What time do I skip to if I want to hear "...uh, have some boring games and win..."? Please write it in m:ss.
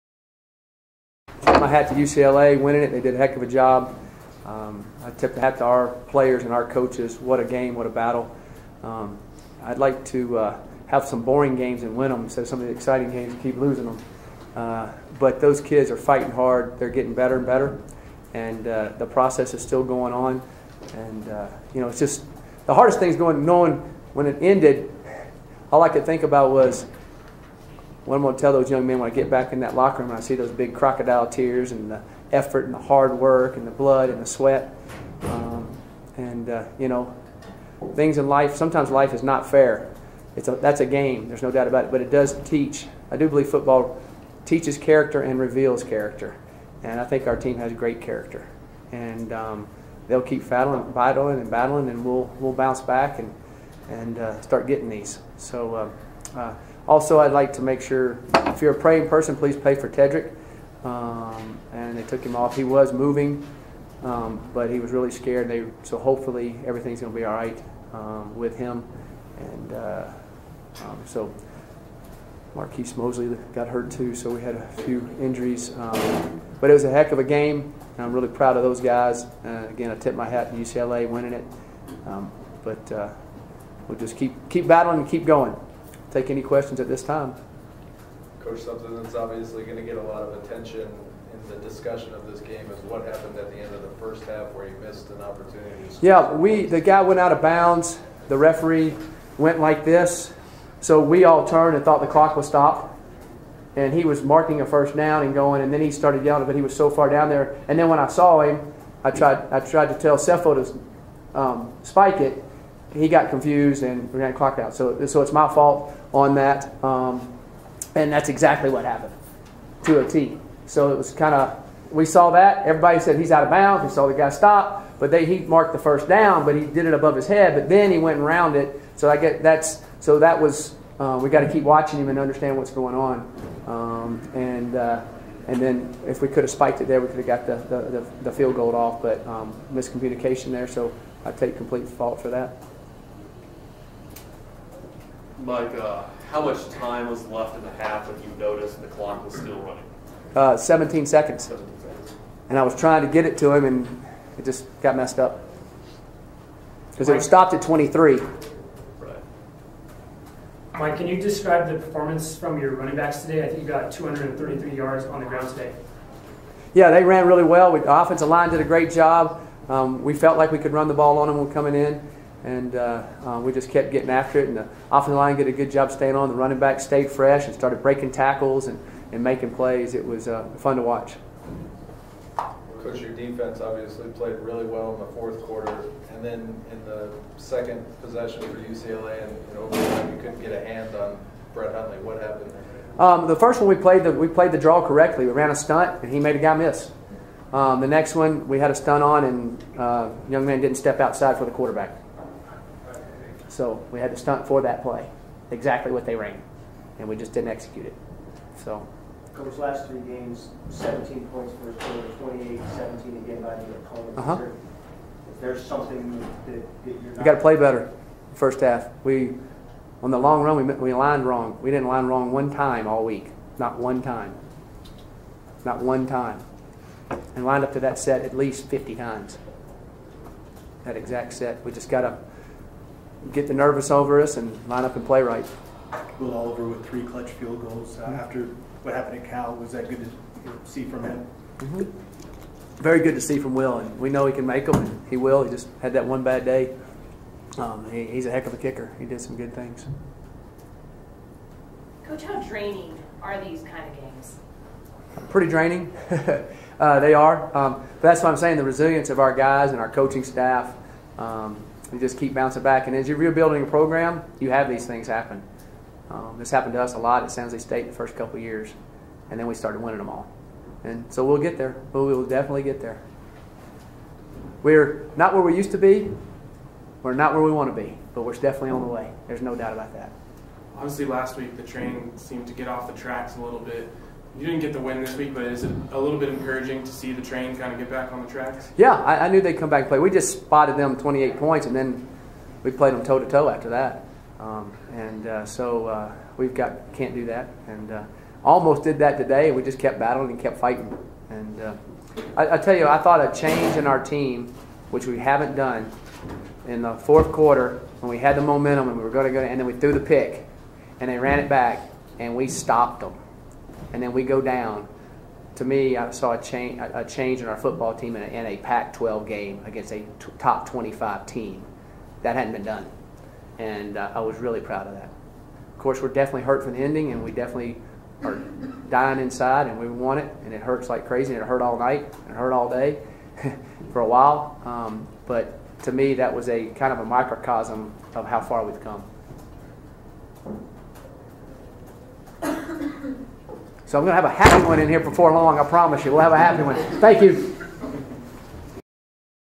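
0:10.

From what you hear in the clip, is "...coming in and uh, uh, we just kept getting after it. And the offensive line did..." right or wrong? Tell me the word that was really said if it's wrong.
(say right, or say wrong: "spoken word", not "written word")
right.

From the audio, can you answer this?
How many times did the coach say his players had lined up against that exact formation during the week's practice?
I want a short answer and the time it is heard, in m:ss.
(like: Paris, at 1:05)
50, at 3:48.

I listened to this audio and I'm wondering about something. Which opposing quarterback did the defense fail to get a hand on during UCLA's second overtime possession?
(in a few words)
Brett Hundley.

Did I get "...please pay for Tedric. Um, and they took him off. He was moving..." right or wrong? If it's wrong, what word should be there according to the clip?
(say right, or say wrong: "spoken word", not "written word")
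right.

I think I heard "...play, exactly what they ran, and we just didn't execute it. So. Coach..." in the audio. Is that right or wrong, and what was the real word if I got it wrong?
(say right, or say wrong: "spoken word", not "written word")
right.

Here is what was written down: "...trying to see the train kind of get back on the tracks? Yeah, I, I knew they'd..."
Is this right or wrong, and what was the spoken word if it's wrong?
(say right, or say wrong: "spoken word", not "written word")
wrong: "encouraging", not "trying".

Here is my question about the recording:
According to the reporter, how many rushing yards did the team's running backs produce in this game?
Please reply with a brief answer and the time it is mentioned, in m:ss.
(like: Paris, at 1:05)
233, at 2:43.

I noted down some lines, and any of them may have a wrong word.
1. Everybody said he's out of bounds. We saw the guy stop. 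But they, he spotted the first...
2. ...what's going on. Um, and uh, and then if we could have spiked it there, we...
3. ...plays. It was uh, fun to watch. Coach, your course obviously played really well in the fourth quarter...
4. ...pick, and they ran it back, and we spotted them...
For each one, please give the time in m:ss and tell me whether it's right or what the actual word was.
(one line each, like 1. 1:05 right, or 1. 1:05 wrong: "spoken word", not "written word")
1. 2:02 wrong: "marked", not "spotted"
2. 2:12 right
3. 2:59 wrong: "defense", not "course"
4. 5:09 wrong: "stopped", not "spotted".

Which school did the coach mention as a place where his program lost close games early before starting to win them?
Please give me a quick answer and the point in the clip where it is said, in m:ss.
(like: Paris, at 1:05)
San Jose State, at 4:27.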